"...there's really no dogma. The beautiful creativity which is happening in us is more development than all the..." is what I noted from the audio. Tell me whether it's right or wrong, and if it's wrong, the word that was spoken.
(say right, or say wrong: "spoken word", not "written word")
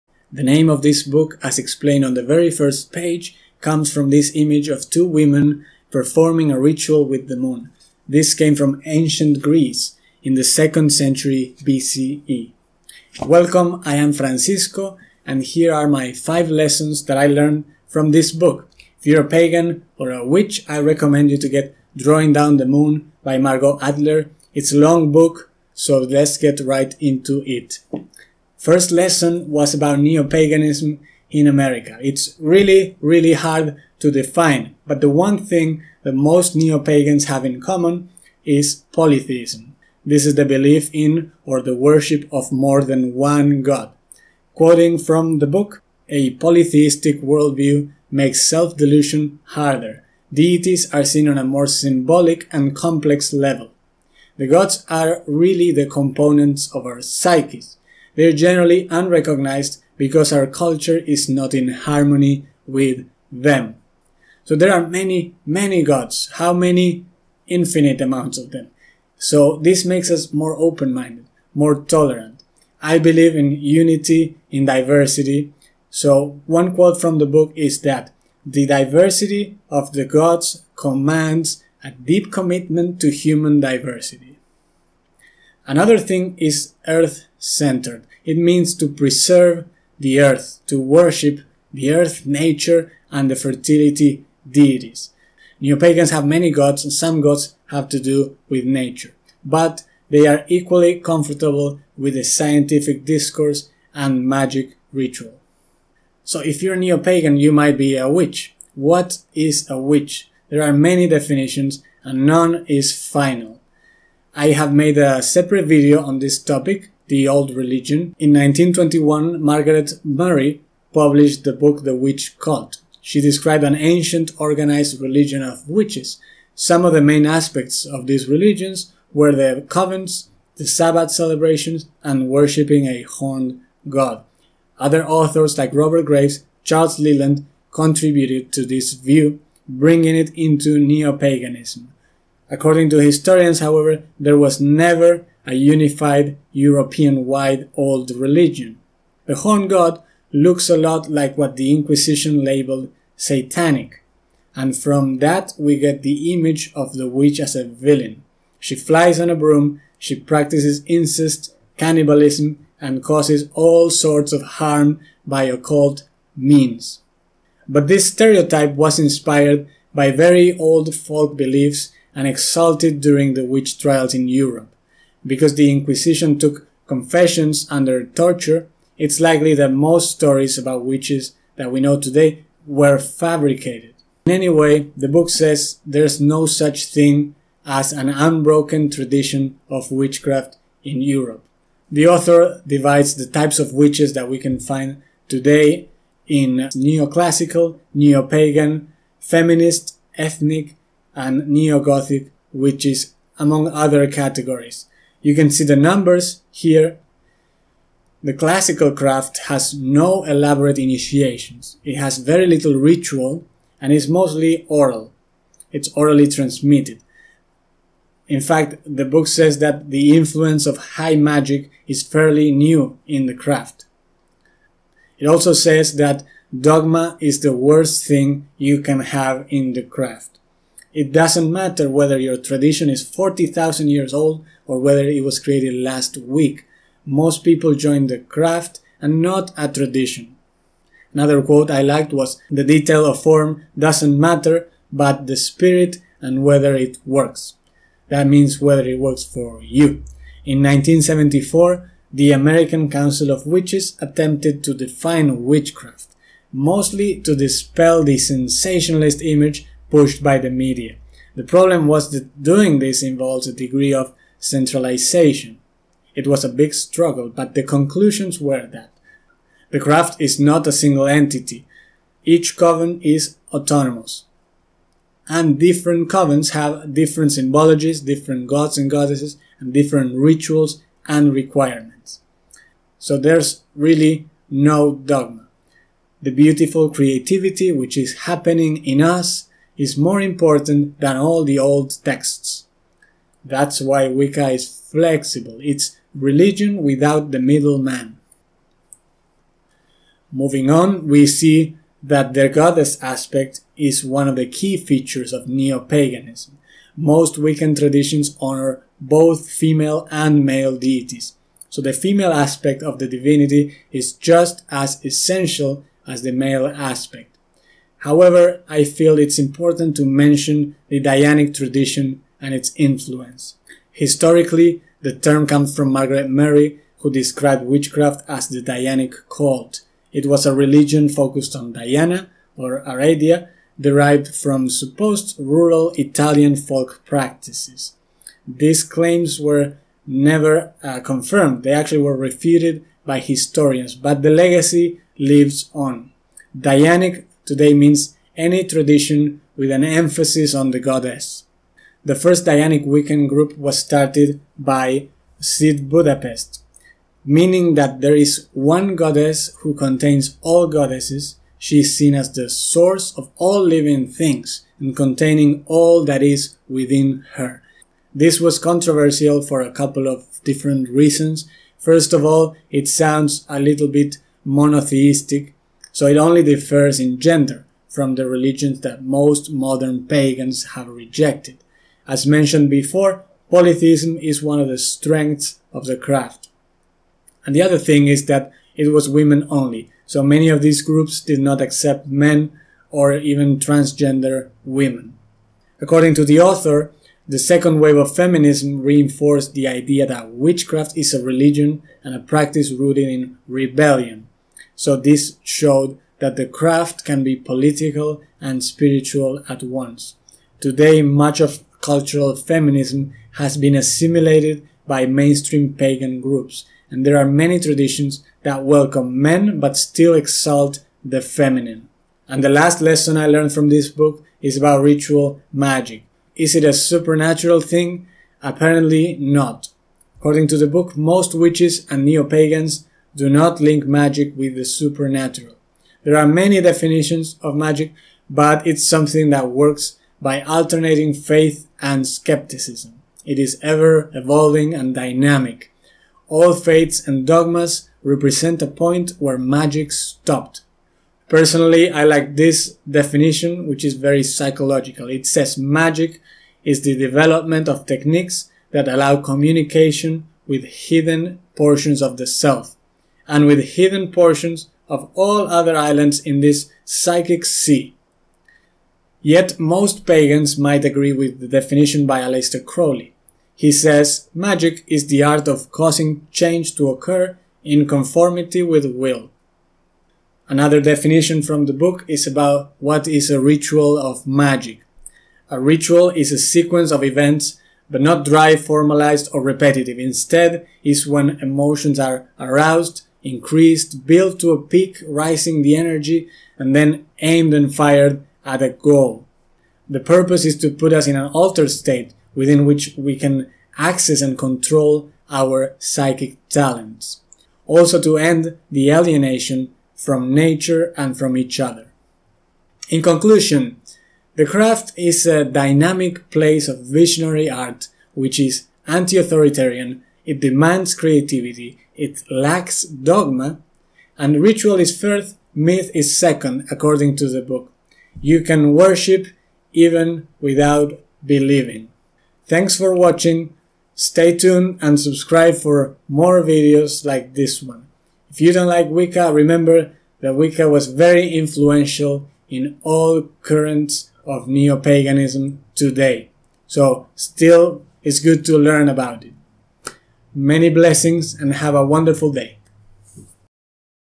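wrong: "important", not "development".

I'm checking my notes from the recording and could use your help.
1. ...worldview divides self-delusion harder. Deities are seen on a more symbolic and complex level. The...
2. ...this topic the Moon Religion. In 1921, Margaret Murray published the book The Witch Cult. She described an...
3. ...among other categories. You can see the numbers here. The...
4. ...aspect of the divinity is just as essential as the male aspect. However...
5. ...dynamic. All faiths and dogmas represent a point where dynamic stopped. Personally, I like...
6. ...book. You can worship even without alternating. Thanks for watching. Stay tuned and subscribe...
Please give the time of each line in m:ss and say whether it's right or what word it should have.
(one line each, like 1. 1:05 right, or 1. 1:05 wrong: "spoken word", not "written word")
1. 0:47 wrong: "makes", not "divides"
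2. 1:56 wrong: "Old", not "Moon"
3. 3:23 right
4. 5:12 right
5. 7:24 wrong: "magic", not "dynamic"
6. 8:47 wrong: "believing", not "alternating".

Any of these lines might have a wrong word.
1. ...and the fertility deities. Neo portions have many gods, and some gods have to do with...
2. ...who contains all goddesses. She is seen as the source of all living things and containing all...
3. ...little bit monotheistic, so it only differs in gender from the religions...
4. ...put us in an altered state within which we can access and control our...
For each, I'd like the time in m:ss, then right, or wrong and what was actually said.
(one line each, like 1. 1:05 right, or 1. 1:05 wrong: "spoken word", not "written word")
1. 1:33 wrong: "pagans", not "portions"
2. 5:59 right
3. 6:13 right
4. 8:20 right.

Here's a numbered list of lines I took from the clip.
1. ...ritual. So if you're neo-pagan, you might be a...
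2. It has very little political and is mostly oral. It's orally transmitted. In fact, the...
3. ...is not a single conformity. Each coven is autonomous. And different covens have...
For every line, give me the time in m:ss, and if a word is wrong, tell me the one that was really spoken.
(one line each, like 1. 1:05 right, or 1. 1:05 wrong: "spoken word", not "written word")
1. 1:44 right
2. 3:31 wrong: "ritual", not "political"
3. 4:30 wrong: "entity", not "conformity".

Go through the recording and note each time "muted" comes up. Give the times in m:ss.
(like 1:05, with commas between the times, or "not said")
not said.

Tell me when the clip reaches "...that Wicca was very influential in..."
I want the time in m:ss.
9:00.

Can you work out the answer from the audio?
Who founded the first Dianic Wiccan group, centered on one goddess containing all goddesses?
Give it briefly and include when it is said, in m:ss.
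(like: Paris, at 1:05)
Z Budapest, at 5:55.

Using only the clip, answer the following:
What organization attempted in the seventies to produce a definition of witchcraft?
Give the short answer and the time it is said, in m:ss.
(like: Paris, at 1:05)
American Council of Witches, at 4:12.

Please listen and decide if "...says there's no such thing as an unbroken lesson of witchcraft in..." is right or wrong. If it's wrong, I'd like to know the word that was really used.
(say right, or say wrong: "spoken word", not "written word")
wrong: "tradition", not "lesson".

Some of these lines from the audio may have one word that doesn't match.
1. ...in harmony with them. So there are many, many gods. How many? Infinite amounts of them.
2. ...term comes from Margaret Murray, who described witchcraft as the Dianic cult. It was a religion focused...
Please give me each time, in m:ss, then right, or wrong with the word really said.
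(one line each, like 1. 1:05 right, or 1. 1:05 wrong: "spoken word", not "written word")
1. 1:01 right
2. 5:25 right.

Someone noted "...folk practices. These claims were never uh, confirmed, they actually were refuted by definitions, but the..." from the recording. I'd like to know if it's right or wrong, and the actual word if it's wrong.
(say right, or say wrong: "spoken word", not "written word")
wrong: "historians", not "definitions".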